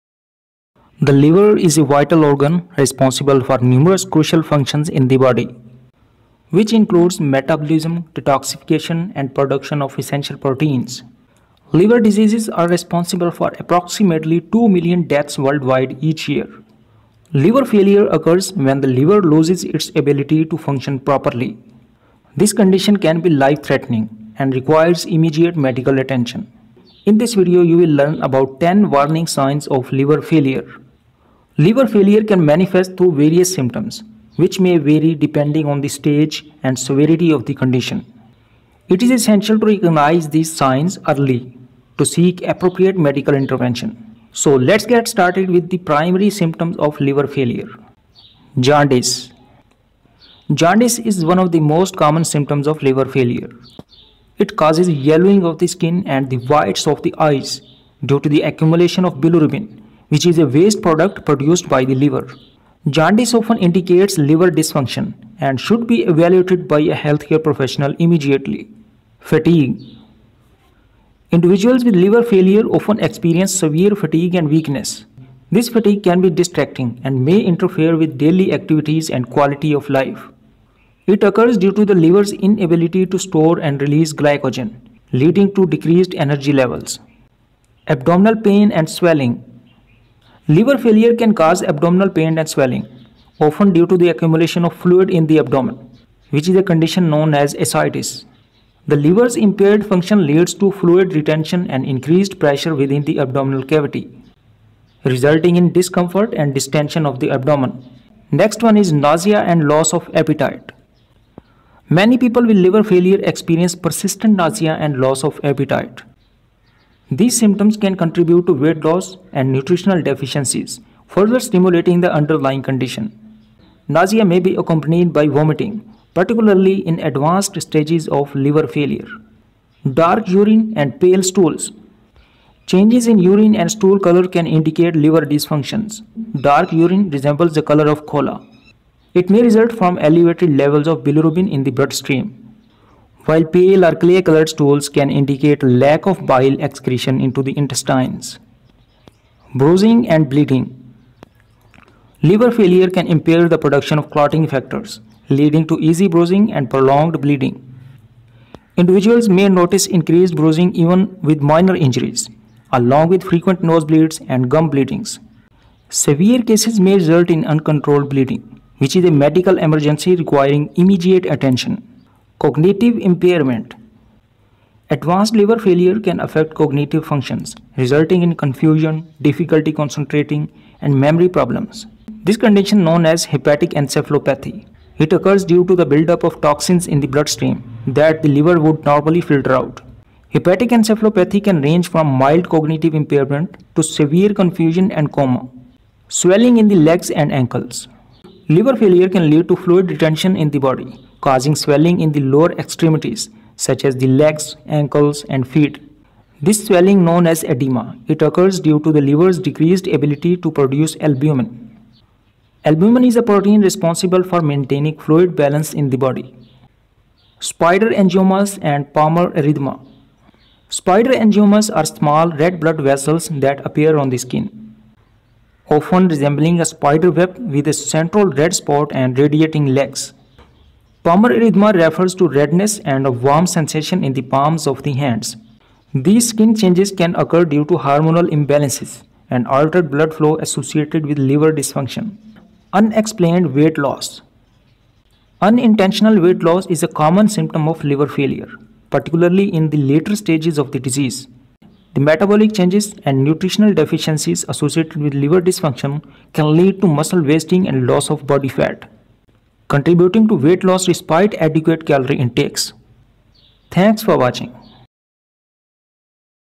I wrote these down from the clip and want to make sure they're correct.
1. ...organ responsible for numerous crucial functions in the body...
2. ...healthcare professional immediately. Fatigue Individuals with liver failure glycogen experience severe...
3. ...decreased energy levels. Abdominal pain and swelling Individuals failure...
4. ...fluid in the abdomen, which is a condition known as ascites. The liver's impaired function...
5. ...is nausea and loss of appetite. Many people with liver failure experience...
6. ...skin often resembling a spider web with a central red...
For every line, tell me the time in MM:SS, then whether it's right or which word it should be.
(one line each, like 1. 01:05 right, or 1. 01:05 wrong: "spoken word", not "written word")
1. 00:02 right
2. 01:07 wrong: "often", not "glycogen"
3. 01:25 wrong: "Liver", not "Individuals"
4. 01:34 right
5. 01:48 right
6. 03:44 right.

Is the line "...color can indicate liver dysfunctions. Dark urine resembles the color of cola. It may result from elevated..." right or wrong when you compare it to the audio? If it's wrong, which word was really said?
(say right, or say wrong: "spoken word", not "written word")
right.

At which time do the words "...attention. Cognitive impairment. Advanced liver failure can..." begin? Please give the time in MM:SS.
02:51.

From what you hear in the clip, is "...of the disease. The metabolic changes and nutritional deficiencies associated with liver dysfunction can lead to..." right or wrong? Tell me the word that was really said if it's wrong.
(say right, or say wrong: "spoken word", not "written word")
right.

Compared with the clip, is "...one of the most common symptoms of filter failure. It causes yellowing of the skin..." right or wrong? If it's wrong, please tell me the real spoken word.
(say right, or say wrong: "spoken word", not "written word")
wrong: "liver", not "filter".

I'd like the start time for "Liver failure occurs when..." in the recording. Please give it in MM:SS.
00:17.